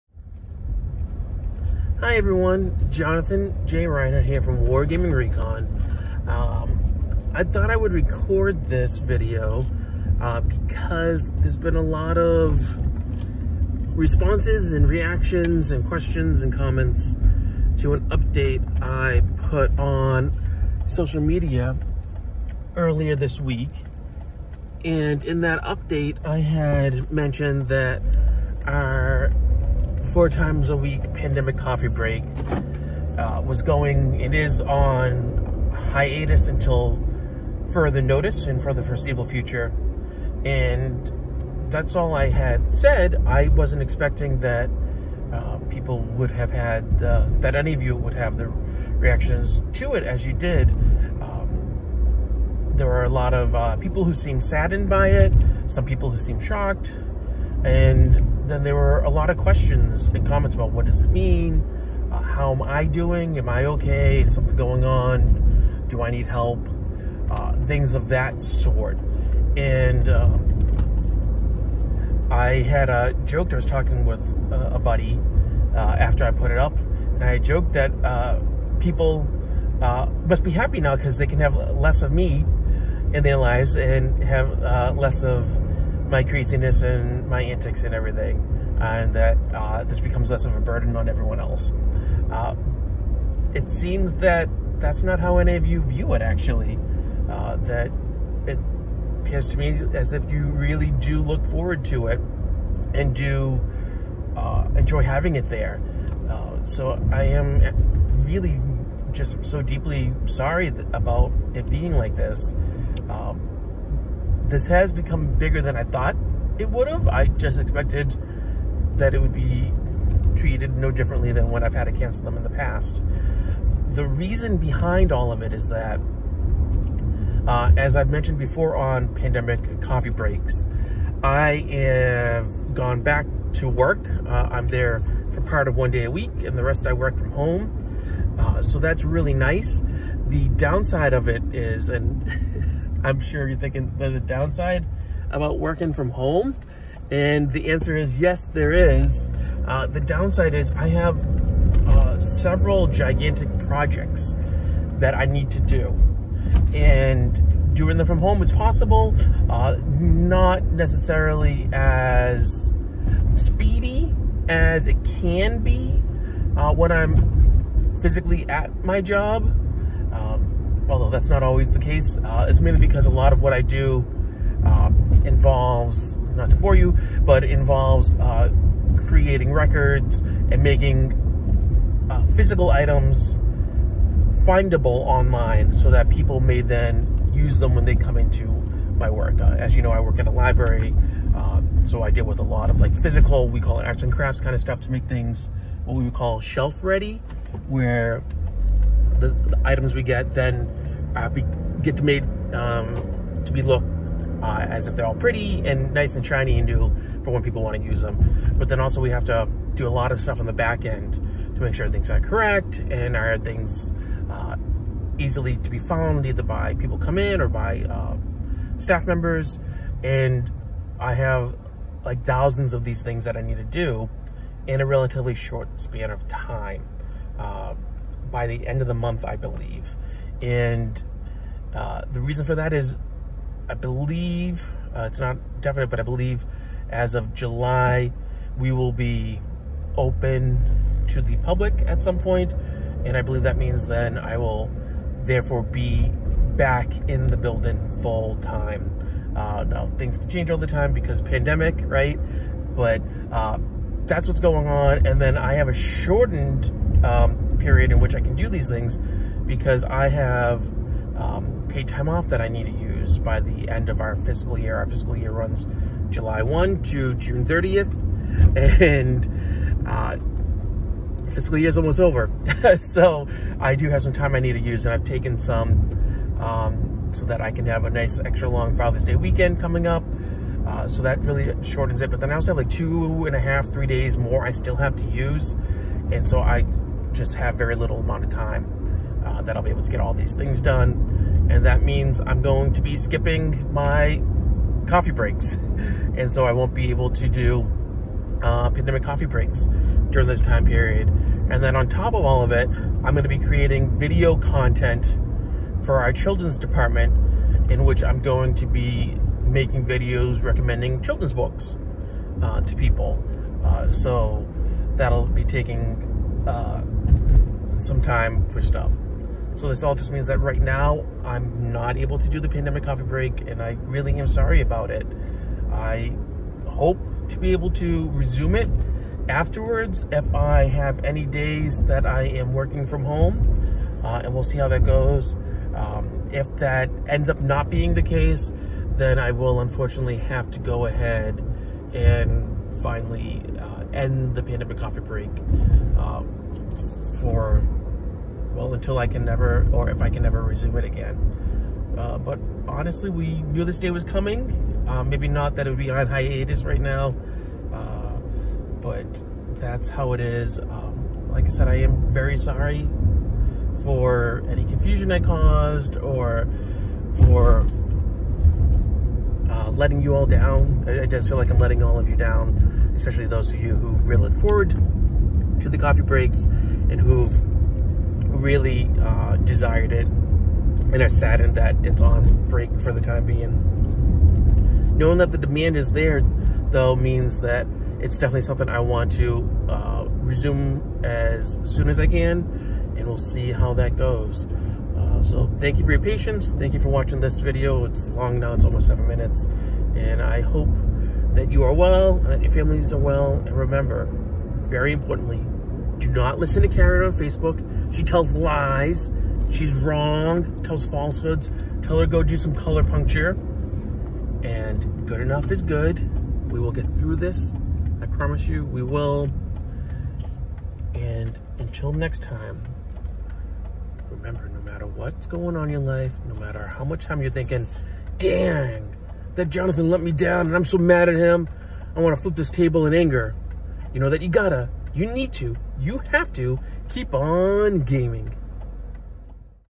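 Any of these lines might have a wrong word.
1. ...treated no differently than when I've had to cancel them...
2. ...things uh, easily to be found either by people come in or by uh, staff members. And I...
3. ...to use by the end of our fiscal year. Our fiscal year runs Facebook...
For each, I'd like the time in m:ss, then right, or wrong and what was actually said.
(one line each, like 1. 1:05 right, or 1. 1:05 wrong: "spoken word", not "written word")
1. 2:00 right
2. 3:33 right
3. 4:22 wrong: "July", not "Facebook".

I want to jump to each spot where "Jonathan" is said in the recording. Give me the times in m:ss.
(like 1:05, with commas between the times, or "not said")
0:02, 7:09.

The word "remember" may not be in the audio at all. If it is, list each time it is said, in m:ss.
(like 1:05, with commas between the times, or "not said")
6:43, 7:04.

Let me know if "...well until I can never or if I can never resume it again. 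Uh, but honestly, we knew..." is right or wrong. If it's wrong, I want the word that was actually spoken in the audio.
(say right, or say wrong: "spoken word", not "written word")
right.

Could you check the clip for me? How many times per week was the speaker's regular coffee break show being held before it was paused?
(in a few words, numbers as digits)
4.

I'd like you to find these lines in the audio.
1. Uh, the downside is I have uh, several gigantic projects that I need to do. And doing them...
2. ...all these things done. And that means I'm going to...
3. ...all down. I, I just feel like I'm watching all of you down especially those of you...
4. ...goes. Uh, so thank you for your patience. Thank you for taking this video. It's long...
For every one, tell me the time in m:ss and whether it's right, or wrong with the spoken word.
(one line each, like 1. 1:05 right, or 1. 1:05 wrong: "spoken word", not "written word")
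1. 2:29 right
2. 4:49 right
3. 6:10 wrong: "letting", not "watching"
4. 6:33 wrong: "watching", not "taking".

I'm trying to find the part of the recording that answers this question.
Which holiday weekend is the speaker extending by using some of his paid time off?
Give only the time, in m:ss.
4:38.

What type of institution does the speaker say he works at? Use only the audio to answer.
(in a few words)
A library.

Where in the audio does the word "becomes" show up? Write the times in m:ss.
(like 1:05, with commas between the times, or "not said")
1:30, 1:54.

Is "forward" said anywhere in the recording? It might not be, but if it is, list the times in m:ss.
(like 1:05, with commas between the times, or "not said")
1:41, 6:14.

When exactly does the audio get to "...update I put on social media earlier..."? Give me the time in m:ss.
0:18.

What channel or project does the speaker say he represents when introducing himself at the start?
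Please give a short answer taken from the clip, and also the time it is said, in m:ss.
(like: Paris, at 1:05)
Wargaming Recon, at 0:04.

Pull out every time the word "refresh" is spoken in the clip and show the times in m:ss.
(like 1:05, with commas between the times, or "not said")
not said.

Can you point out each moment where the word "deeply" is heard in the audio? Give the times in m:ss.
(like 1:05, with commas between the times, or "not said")
1:49.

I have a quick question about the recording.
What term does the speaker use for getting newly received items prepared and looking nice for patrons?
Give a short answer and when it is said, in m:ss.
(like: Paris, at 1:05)
Shelf ready, at 3:16.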